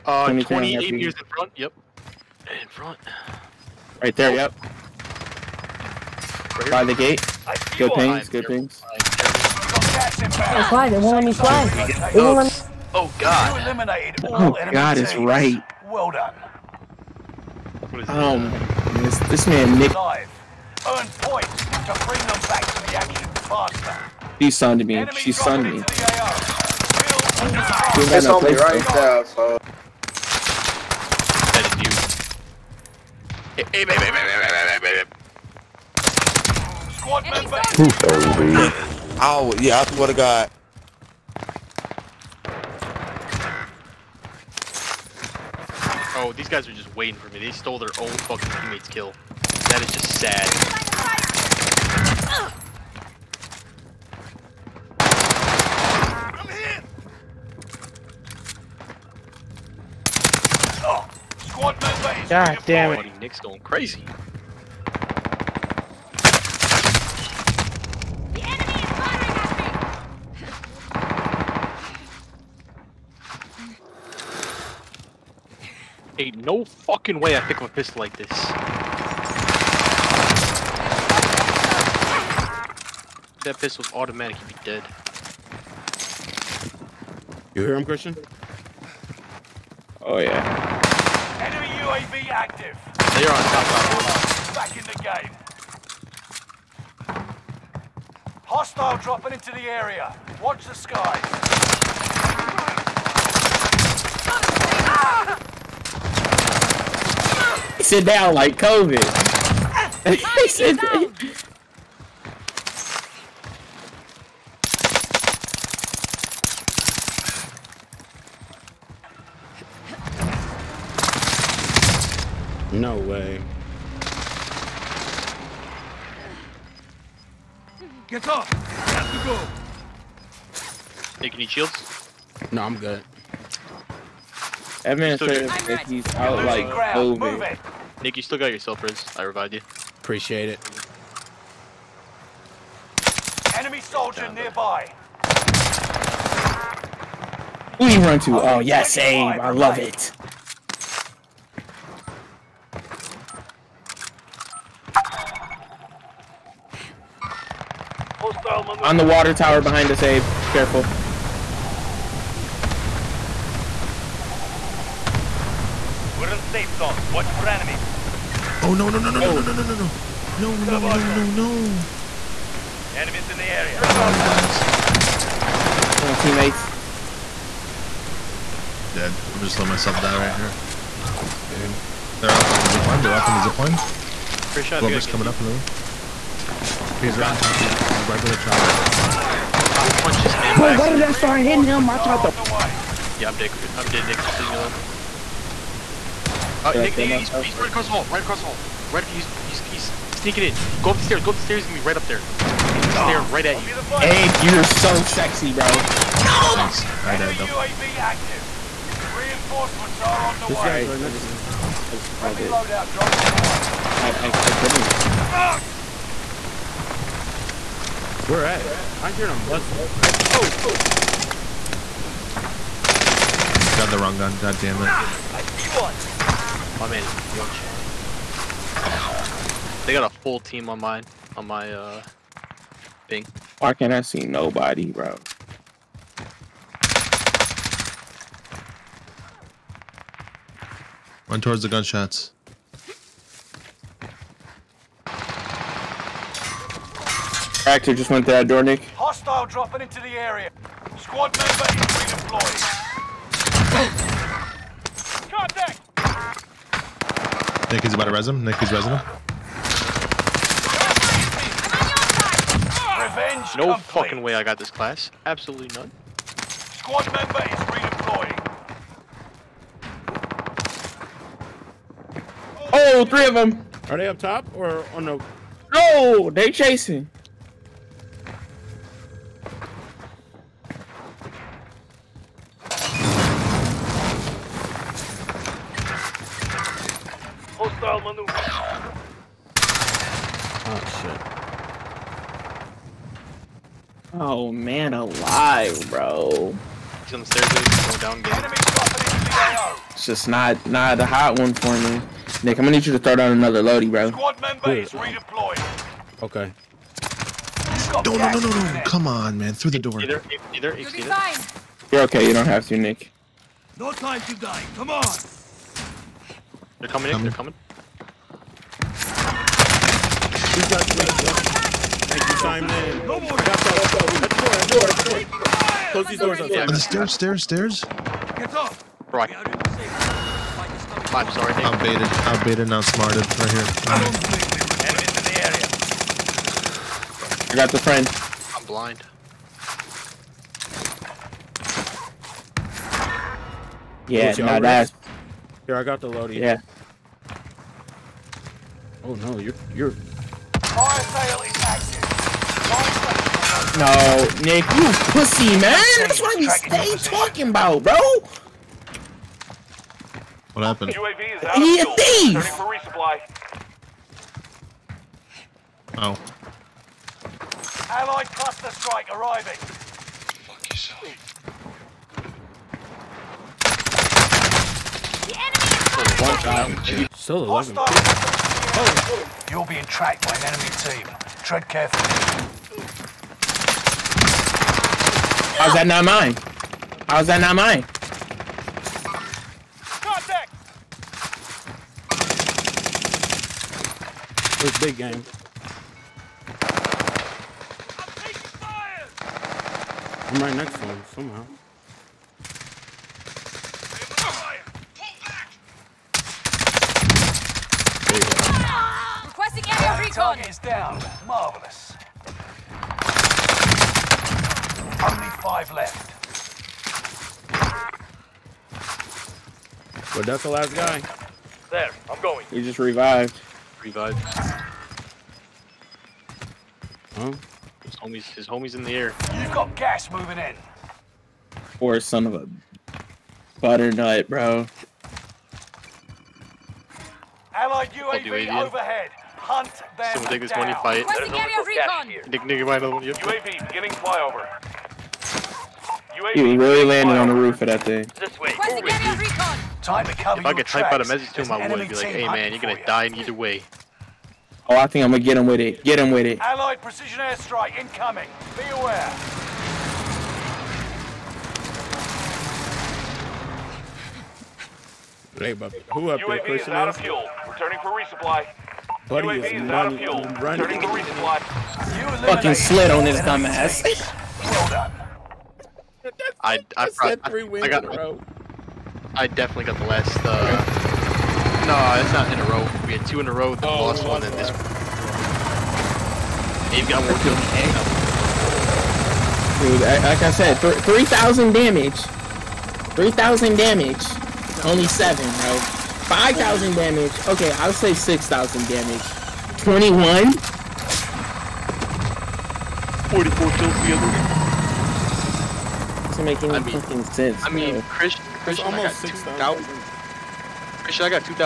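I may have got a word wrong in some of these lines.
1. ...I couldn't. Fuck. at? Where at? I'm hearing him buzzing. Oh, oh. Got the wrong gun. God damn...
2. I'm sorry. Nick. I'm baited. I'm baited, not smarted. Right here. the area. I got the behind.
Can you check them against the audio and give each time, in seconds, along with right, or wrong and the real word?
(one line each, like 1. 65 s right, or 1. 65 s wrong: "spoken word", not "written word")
1. 214 s right
2. 331 s wrong: "friend", not "behind".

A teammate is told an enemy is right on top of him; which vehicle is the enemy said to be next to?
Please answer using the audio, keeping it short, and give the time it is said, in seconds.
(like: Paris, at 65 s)
chopper, at 188 s.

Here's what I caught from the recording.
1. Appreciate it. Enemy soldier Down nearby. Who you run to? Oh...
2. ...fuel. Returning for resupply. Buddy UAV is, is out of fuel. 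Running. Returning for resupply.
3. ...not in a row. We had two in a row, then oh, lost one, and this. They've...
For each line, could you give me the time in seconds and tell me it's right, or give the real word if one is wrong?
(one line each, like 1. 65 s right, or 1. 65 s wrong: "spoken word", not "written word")
1. 140 s right
2. 466 s right
3. 482 s right.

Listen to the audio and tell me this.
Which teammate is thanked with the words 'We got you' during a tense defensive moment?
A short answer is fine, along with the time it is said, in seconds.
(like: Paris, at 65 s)
Simon, at 322 s.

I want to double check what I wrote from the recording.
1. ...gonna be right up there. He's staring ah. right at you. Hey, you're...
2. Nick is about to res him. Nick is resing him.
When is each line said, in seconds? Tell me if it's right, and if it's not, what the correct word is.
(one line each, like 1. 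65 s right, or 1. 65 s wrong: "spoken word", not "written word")
1. 201 s right
2. 257 s right.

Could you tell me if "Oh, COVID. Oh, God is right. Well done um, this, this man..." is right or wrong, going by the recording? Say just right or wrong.
wrong.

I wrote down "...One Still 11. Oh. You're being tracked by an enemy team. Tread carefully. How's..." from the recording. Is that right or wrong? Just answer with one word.
right.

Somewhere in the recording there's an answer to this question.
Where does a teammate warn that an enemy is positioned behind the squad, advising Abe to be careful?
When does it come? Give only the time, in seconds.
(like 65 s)
159 s.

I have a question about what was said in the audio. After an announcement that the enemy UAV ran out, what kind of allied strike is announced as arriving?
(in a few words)
cluster strike.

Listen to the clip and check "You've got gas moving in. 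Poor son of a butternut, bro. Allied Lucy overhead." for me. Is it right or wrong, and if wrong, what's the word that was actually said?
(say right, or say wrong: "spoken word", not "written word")
wrong: "UAV", not "Lucy".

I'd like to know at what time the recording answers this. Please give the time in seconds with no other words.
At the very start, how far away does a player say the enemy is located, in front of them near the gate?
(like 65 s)
0 s.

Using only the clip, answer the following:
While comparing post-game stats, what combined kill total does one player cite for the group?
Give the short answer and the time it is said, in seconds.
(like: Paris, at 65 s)
44, at 503 s.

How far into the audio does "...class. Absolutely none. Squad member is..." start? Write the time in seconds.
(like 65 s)
264 s.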